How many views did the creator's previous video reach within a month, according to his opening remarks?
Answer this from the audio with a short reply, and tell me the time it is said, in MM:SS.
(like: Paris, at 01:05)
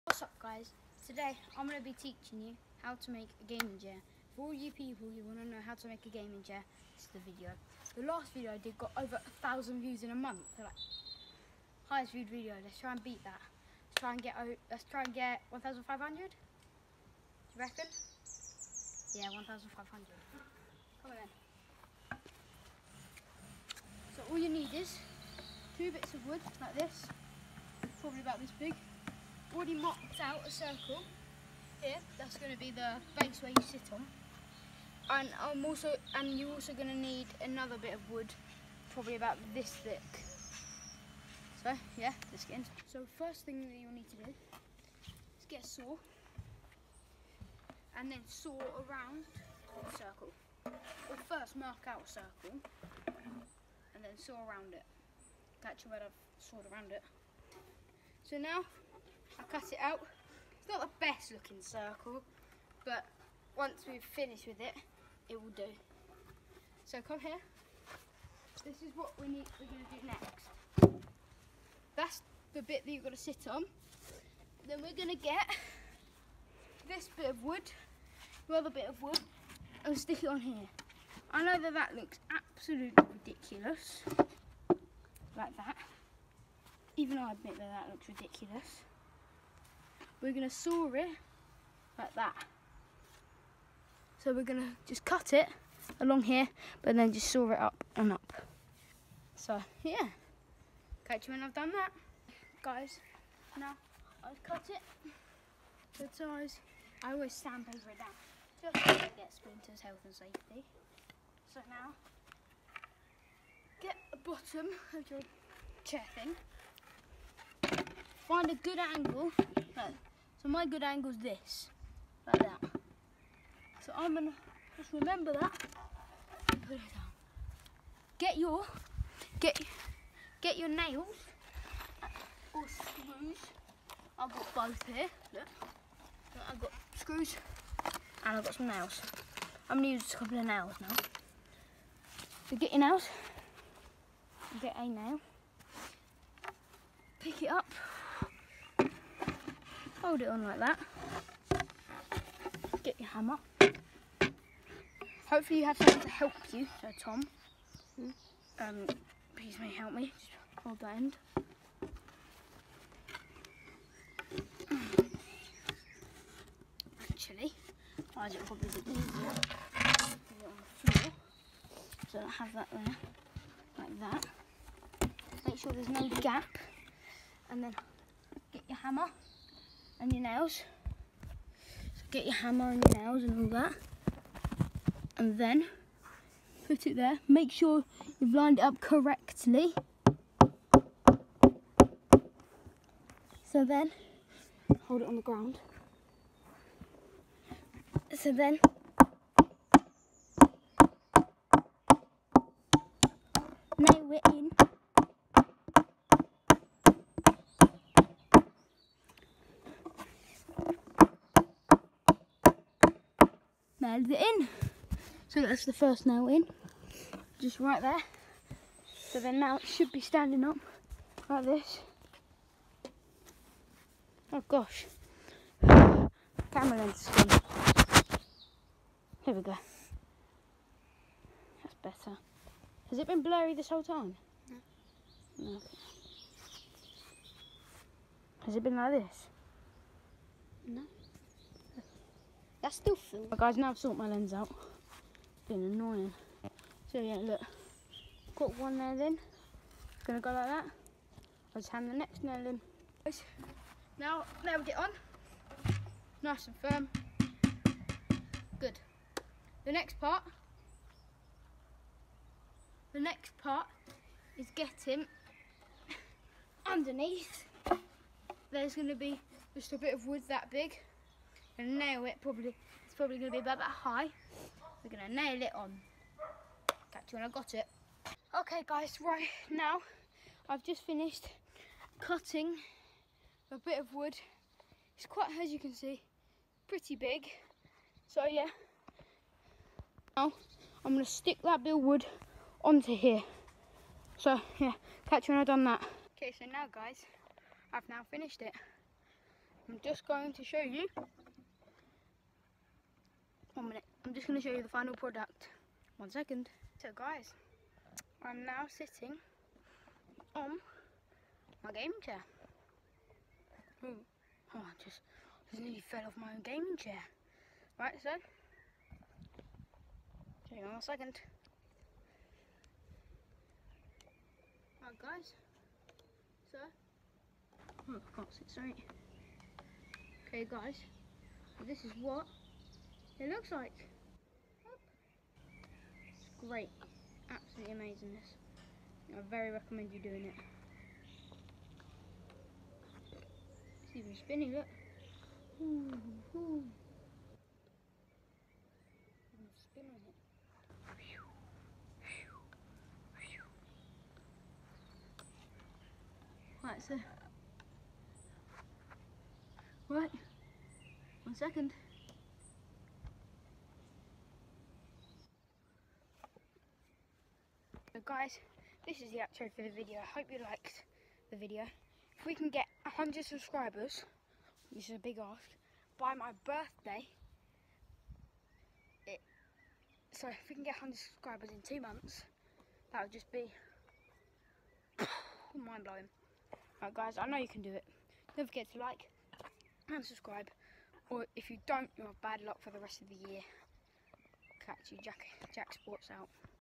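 over 1,000, at 00:08.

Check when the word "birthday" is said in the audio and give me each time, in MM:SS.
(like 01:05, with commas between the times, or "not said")
06:16.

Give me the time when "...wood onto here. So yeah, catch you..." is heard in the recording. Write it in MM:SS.
04:51.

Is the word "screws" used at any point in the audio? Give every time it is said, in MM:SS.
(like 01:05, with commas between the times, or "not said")
02:12, 02:16.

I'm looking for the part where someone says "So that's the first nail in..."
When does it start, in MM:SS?
03:35.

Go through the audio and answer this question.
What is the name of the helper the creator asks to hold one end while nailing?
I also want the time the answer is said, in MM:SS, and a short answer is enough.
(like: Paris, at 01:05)
Tom, at 02:36.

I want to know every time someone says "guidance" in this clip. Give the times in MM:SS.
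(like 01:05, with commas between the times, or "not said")
not said.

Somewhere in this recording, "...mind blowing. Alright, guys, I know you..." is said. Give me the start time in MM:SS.
06:25.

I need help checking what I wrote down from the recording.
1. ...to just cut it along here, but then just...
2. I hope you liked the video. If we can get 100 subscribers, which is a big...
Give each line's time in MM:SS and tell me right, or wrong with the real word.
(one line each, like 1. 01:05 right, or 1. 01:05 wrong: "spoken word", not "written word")
1. 01:34 right
2. 06:09 right.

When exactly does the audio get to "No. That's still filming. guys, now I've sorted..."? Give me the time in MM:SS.
04:00.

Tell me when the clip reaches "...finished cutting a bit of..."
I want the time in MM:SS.
04:40.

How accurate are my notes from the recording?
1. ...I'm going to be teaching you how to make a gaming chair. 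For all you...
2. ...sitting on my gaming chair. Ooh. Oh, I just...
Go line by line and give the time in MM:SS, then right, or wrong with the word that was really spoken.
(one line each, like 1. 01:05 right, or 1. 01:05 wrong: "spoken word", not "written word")
1. 00:01 right
2. 05:08 right.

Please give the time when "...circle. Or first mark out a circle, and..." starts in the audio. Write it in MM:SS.
00:49.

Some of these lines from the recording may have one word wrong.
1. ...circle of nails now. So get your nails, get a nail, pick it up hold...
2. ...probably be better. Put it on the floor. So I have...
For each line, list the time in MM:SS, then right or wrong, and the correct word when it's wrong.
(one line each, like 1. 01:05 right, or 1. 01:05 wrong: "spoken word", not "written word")
1. 02:20 wrong: "couple", not "circle"
2. 02:48 wrong: "easier", not "better".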